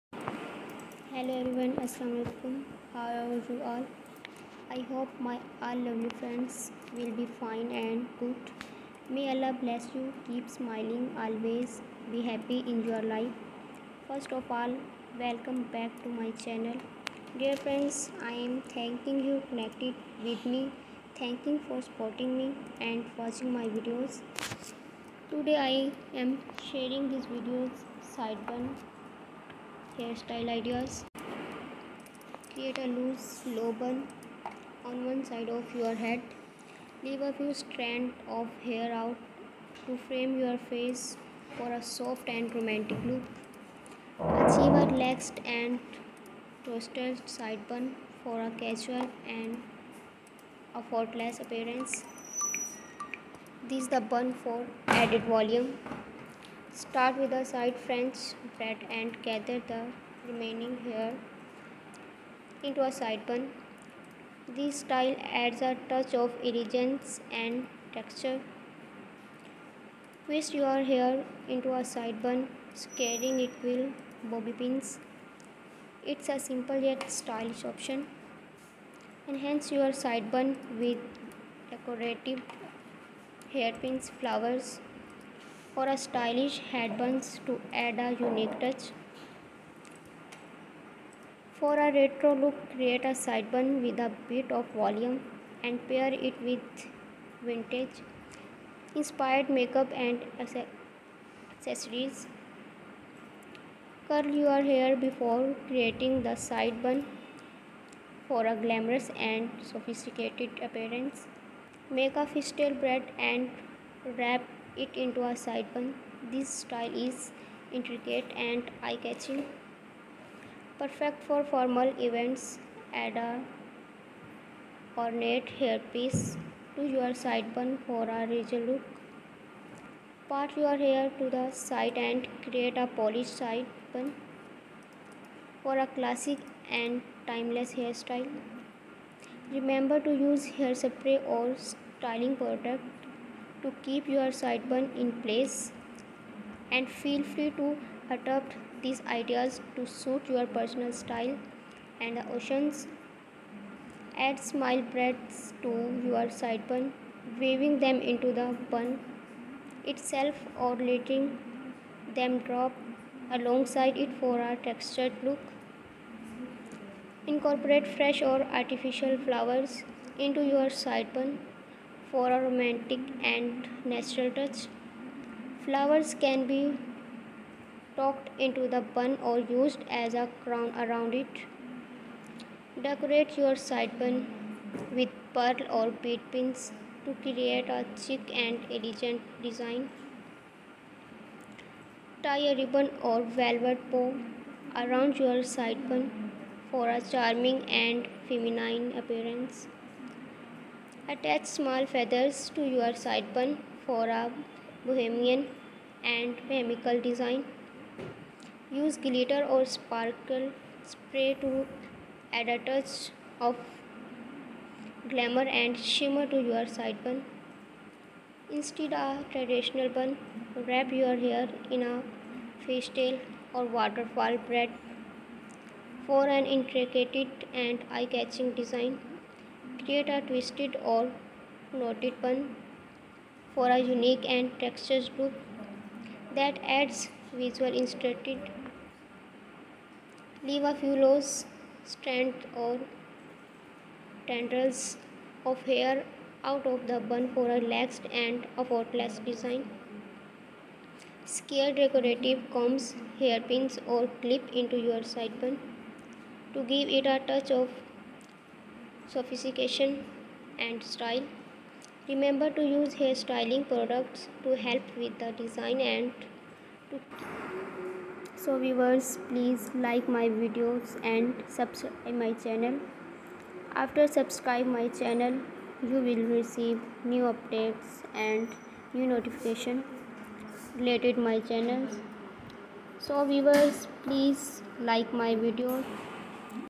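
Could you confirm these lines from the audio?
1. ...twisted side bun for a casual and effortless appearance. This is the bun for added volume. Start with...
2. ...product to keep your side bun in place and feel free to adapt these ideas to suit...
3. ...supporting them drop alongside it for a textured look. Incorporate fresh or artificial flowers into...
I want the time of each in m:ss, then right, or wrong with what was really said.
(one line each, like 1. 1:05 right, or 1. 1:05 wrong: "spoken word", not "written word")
1. 0:46 right
2. 2:22 right
3. 2:40 wrong: "letting", not "supporting".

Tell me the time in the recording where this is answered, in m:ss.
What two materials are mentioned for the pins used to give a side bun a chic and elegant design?
3:05.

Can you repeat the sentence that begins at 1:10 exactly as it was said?
Twist your hair into a side bun, scaring it with bobby pins.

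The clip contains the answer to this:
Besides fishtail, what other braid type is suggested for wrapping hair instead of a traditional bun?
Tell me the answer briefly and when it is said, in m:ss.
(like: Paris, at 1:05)
waterfall braid, at 3:43.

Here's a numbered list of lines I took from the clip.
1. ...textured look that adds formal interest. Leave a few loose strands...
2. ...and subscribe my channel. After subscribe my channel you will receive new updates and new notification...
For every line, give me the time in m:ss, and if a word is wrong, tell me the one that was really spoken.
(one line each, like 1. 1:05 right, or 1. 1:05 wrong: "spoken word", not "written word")
1. 3:54 wrong: "visual", not "formal"
2. 4:31 right.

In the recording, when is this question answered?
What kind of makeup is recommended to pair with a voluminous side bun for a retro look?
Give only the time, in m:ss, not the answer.
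1:37.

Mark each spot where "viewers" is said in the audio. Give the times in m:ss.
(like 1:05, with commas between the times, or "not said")
4:28, 4:43.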